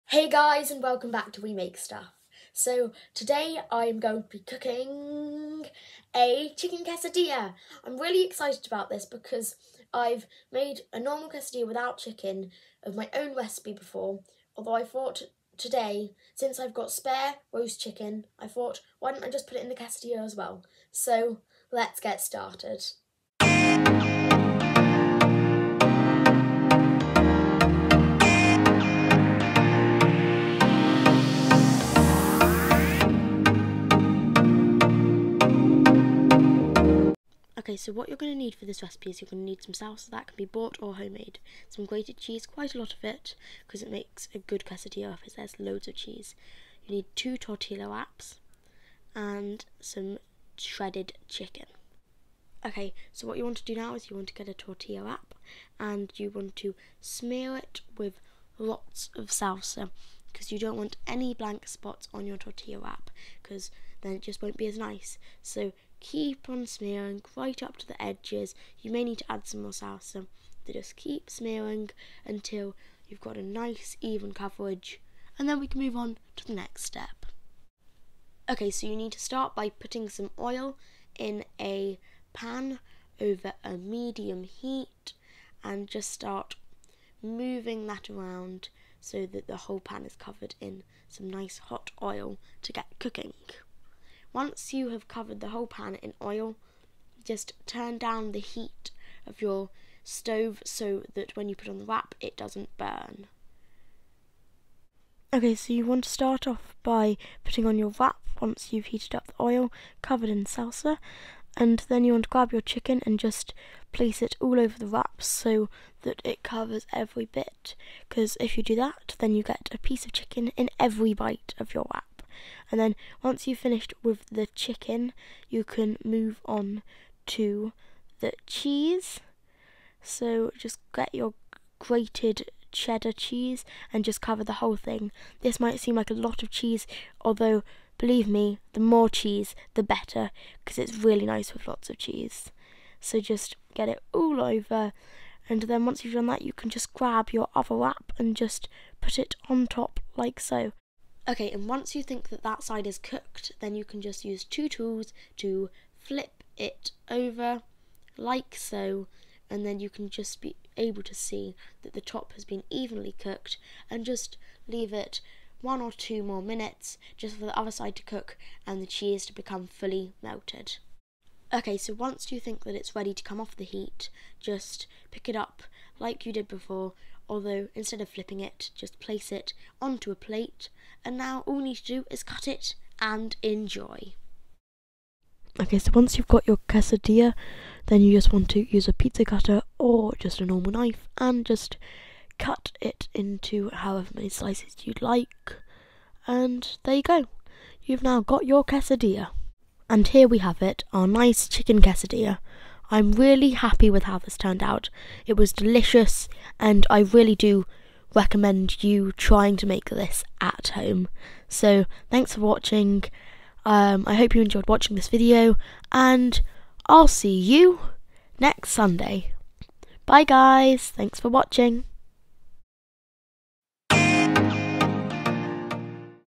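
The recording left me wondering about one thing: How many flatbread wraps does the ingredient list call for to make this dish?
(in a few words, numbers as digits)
2.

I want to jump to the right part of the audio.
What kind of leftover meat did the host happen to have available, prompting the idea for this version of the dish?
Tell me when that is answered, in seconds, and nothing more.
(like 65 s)
17 s.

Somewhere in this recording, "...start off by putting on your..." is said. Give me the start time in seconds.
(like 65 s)
106 s.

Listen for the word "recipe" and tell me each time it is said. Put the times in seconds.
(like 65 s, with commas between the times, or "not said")
13 s, 38 s.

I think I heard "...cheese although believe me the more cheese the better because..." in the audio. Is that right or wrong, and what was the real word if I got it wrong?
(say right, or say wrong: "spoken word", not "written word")
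right.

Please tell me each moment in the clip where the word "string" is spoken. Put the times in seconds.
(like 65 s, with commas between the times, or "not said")
not said.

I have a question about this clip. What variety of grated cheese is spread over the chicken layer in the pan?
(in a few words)
cheddar.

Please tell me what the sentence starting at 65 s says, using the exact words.
So keep on smearing right up to the edges.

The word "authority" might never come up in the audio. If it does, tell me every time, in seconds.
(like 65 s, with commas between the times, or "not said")
not said.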